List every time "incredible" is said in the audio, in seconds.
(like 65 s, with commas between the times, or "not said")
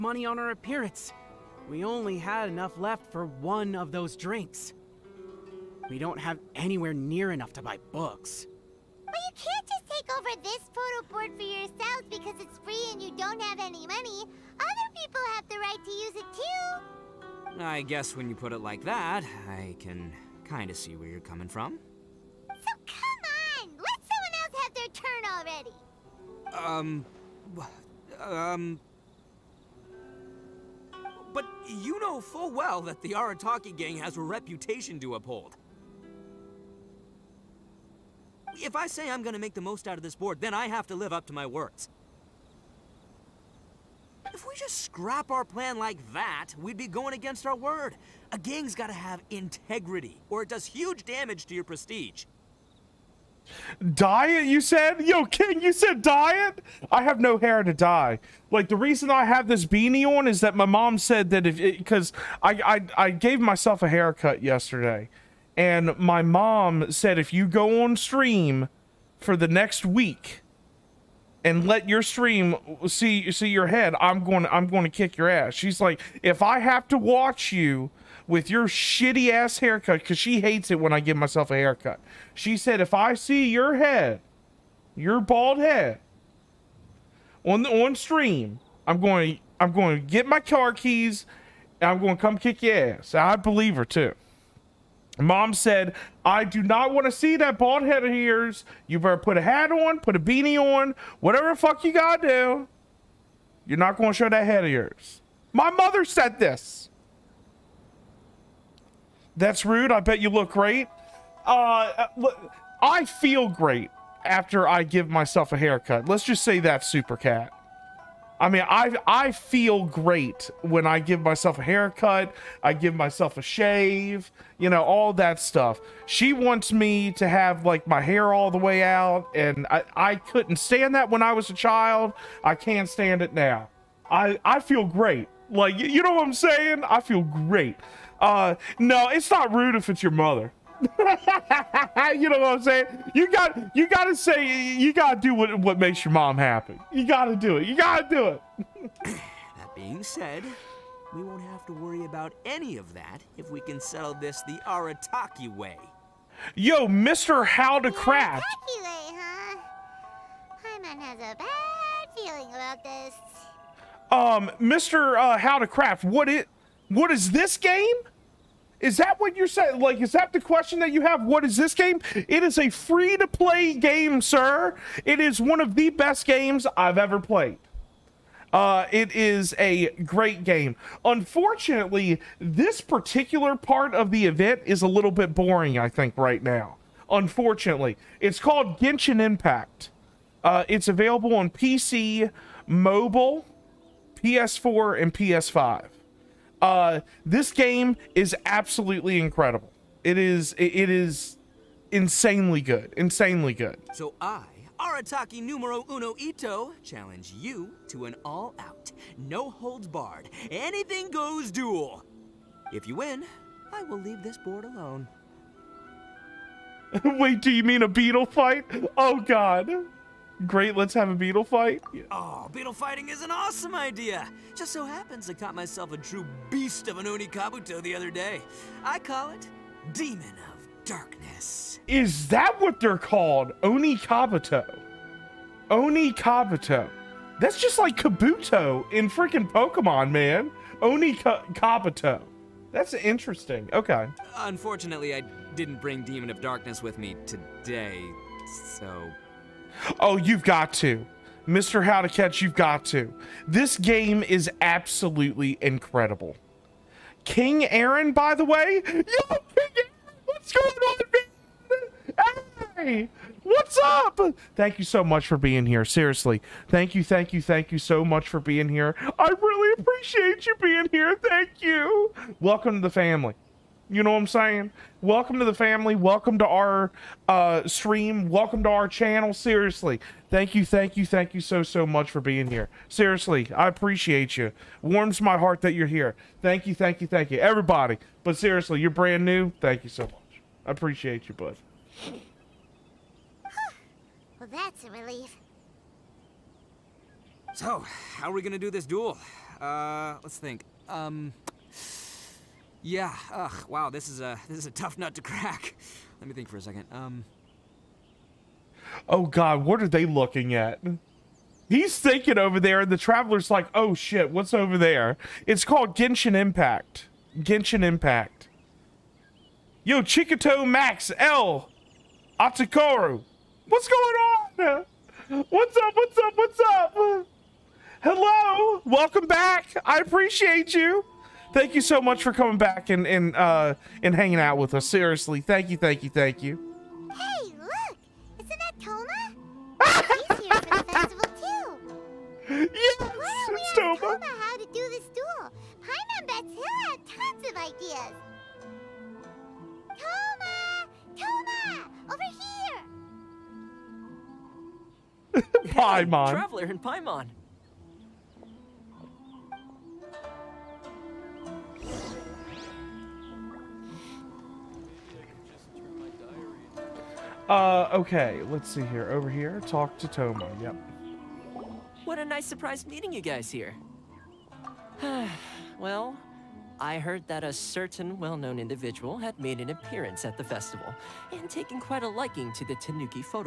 199 s, 255 s.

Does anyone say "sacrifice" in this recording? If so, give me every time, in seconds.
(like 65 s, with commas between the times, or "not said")
not said.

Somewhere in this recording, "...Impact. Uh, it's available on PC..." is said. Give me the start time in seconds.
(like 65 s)
189 s.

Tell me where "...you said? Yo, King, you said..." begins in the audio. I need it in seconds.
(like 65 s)
54 s.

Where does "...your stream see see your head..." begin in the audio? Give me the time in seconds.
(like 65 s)
71 s.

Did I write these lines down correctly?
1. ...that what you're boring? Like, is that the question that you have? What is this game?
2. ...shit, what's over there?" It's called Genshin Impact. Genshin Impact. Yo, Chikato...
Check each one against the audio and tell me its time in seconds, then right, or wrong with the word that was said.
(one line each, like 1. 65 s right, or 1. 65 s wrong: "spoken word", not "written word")
1. 168 s wrong: "saying", not "boring"
2. 313 s right.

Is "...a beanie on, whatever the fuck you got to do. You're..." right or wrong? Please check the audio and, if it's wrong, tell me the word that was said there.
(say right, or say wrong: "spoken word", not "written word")
right.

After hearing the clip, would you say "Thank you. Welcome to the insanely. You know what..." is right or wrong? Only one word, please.
wrong.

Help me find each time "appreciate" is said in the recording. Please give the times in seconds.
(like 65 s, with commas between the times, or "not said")
269 s, 283 s, 290 s, 329 s.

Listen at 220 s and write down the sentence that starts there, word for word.
Great, let's have a beetle fight.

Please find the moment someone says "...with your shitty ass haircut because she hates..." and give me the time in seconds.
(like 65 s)
78 s.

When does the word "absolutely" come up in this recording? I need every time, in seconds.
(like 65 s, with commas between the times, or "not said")
198 s, 254 s.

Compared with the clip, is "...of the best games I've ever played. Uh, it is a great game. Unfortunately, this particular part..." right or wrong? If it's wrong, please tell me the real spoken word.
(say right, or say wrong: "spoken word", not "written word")
right.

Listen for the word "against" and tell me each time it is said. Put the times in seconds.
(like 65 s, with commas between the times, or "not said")
47 s.